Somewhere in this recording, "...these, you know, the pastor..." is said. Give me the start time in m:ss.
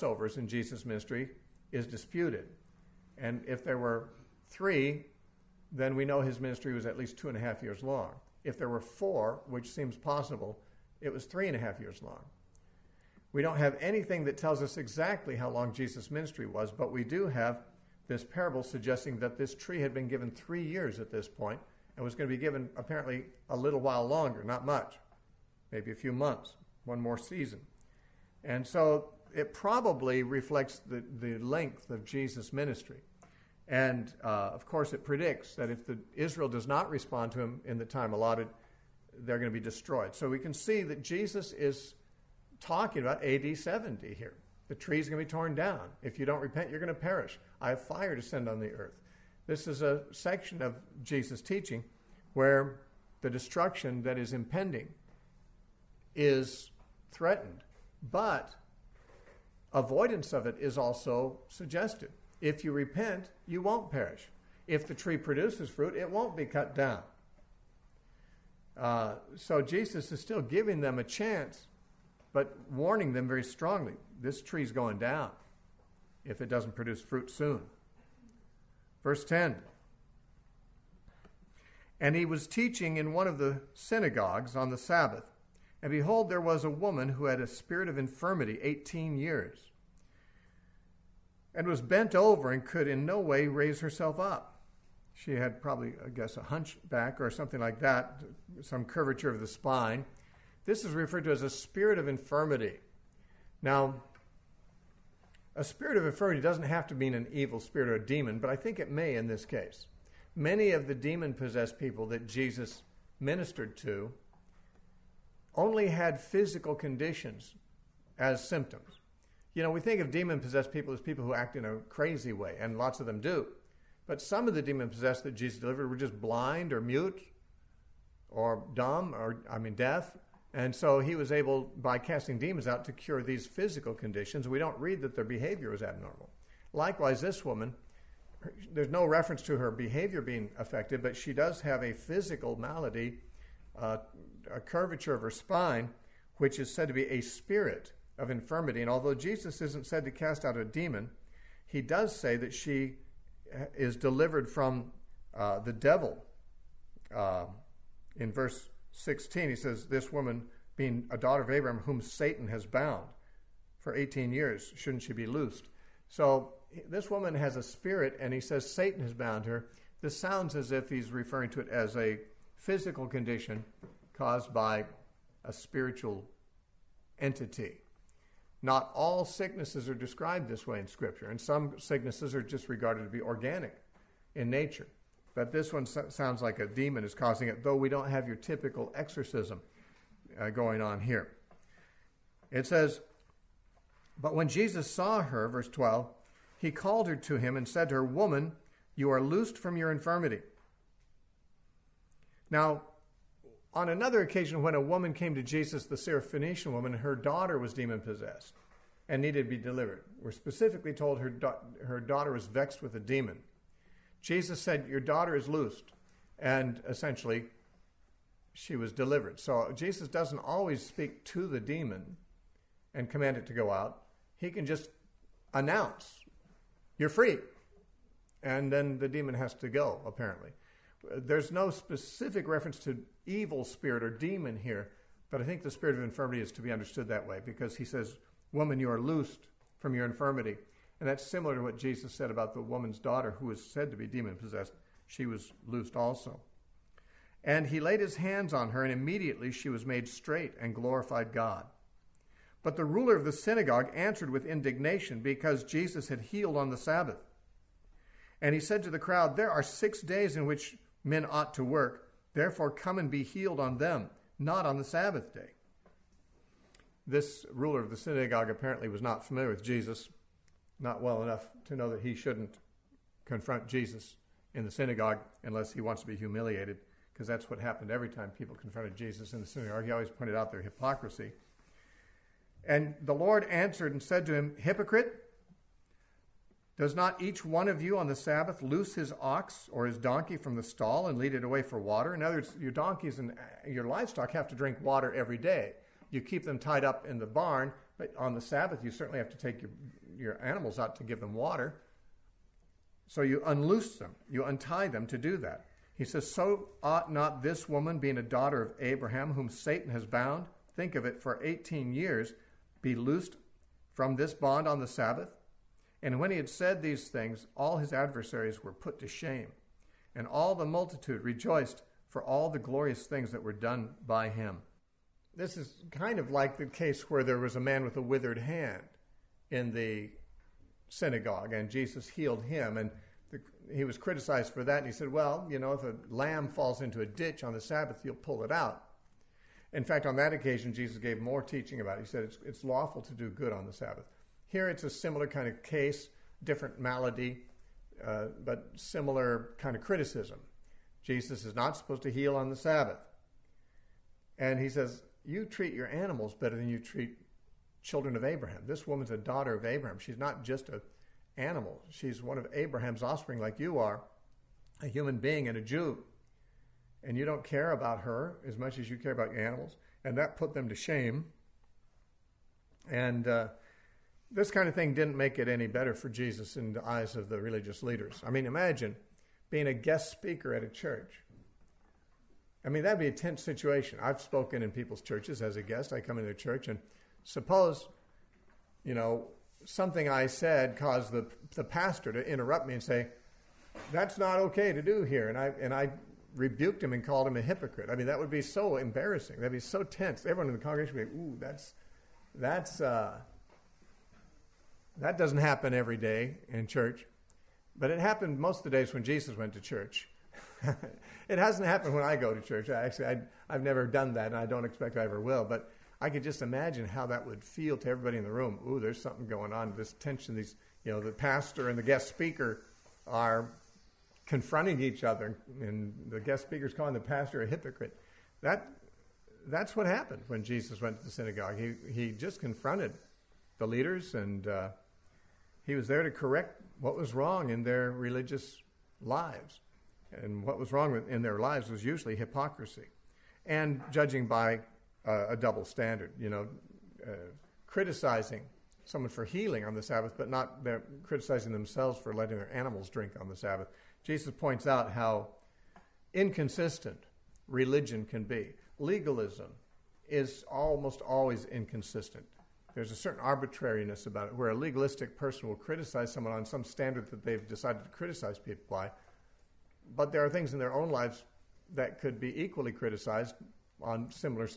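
7:00.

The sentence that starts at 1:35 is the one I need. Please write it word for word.
She had probably, I guess, a hunchback or something like that, some curvature of the spine.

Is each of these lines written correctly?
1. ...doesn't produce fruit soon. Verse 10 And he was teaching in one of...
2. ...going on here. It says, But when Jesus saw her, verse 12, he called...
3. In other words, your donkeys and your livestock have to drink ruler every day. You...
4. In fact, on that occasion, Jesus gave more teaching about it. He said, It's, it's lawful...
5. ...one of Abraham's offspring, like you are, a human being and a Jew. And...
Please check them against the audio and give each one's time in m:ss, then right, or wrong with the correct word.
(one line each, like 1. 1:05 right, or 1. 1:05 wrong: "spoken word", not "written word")
1. 1:16 right
2. 3:10 right
3. 4:52 wrong: "water", not "ruler"
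4. 5:39 right
5. 6:02 right.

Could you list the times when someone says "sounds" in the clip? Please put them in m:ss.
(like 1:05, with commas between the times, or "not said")
2:50, 3:05.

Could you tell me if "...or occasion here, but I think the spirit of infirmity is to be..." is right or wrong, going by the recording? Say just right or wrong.
wrong.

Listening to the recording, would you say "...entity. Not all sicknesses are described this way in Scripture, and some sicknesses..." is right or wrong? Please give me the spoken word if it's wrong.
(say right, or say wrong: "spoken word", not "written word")
right.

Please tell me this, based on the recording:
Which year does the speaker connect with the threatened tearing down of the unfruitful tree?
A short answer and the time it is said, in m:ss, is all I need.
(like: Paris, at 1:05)
AD 70, at 0:43.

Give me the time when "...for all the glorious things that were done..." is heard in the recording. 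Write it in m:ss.
5:22.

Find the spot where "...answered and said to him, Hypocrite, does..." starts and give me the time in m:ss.
4:43.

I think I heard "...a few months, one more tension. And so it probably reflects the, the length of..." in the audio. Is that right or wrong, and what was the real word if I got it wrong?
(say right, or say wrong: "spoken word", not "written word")
wrong: "season", not "tension".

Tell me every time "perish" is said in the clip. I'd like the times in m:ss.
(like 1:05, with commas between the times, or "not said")
0:46, 1:03.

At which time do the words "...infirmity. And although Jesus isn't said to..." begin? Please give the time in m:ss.
2:28.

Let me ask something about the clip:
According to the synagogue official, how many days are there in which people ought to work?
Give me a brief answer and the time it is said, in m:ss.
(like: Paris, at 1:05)
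6, at 4:19.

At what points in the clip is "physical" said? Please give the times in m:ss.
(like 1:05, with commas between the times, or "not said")
1:56, 2:13, 2:21, 2:52.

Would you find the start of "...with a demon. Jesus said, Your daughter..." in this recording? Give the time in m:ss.
3:32.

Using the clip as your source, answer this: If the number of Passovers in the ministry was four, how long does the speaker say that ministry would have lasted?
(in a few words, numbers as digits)
3.5 years.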